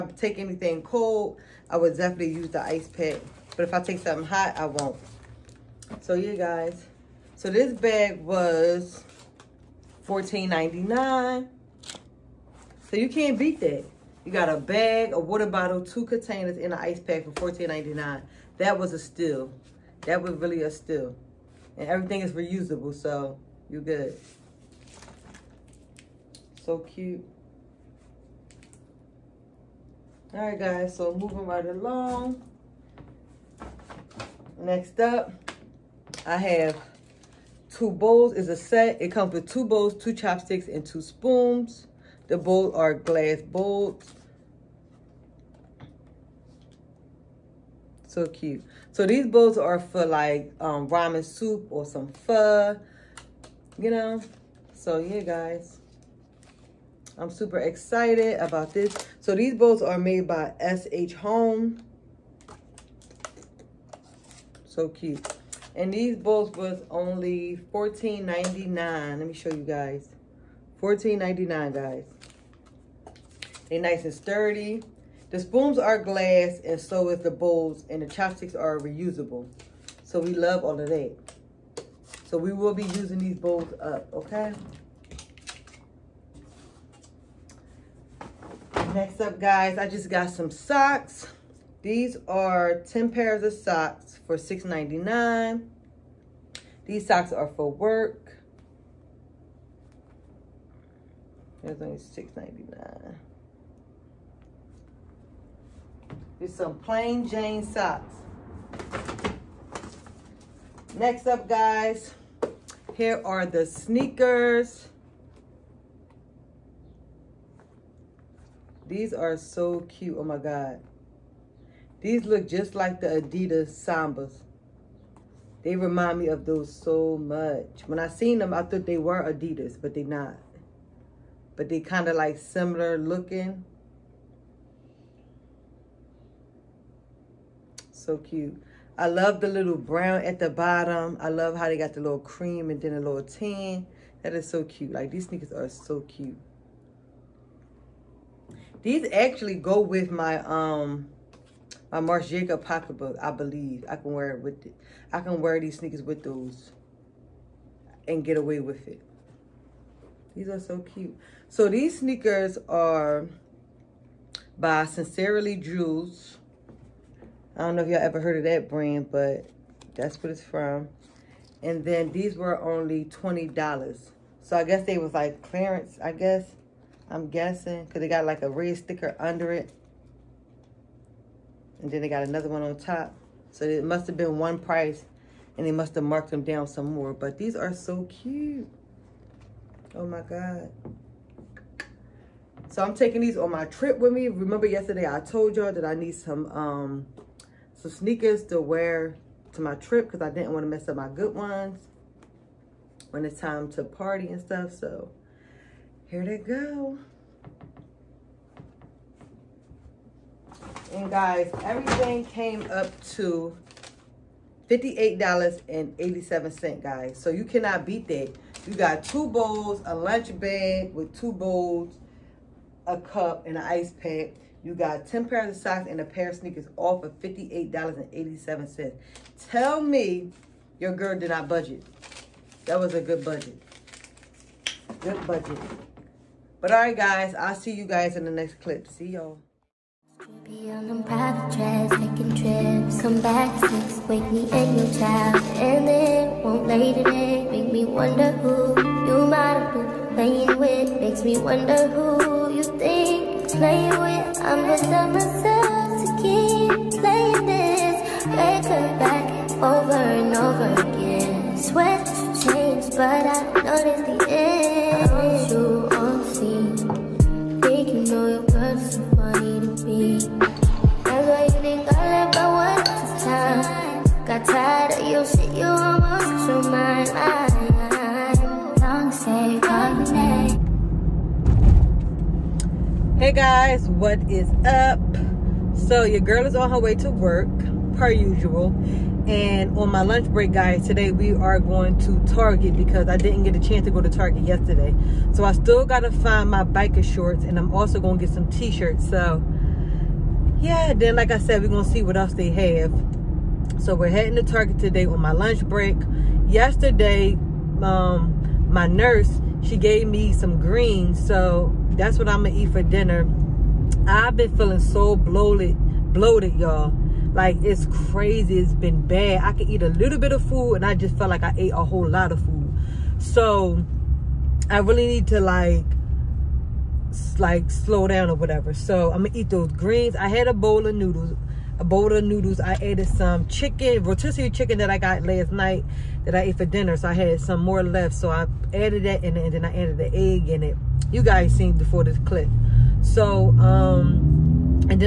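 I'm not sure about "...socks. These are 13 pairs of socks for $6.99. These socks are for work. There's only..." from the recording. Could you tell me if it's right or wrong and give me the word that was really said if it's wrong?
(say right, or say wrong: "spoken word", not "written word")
wrong: "10", not "13".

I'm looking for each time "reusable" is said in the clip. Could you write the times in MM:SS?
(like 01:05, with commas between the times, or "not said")
00:22, 01:18.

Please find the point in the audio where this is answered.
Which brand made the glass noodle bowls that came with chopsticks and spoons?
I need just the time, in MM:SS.
01:00.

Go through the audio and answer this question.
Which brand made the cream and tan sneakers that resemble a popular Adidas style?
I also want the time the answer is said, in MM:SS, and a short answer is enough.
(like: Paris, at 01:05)
Sincerely Jules, at 02:44.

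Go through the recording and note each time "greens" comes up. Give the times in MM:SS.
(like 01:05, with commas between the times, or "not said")
05:10, 05:29.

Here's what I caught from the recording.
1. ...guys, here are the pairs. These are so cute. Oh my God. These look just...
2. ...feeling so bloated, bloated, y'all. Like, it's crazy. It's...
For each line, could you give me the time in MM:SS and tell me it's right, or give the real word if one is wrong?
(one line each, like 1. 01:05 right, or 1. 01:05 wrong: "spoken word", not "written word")
1. 01:51 wrong: "sneakers", not "pairs"
2. 05:14 right.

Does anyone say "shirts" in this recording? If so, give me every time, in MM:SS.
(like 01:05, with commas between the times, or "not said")
04:58.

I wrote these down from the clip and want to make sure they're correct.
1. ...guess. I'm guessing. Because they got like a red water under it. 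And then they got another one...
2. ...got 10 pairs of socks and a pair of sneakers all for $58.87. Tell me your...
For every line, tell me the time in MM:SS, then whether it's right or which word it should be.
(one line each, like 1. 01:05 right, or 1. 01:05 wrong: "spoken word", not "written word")
1. 02:56 wrong: "sticker", not "water"
2. 03:44 right.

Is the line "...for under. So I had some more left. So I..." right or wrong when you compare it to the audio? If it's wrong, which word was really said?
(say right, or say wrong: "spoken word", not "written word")
wrong: "dinner", not "under".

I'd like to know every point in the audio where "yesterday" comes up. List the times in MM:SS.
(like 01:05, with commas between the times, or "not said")
03:14, 04:54, 05:06.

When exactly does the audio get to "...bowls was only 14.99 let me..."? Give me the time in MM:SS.
01:06.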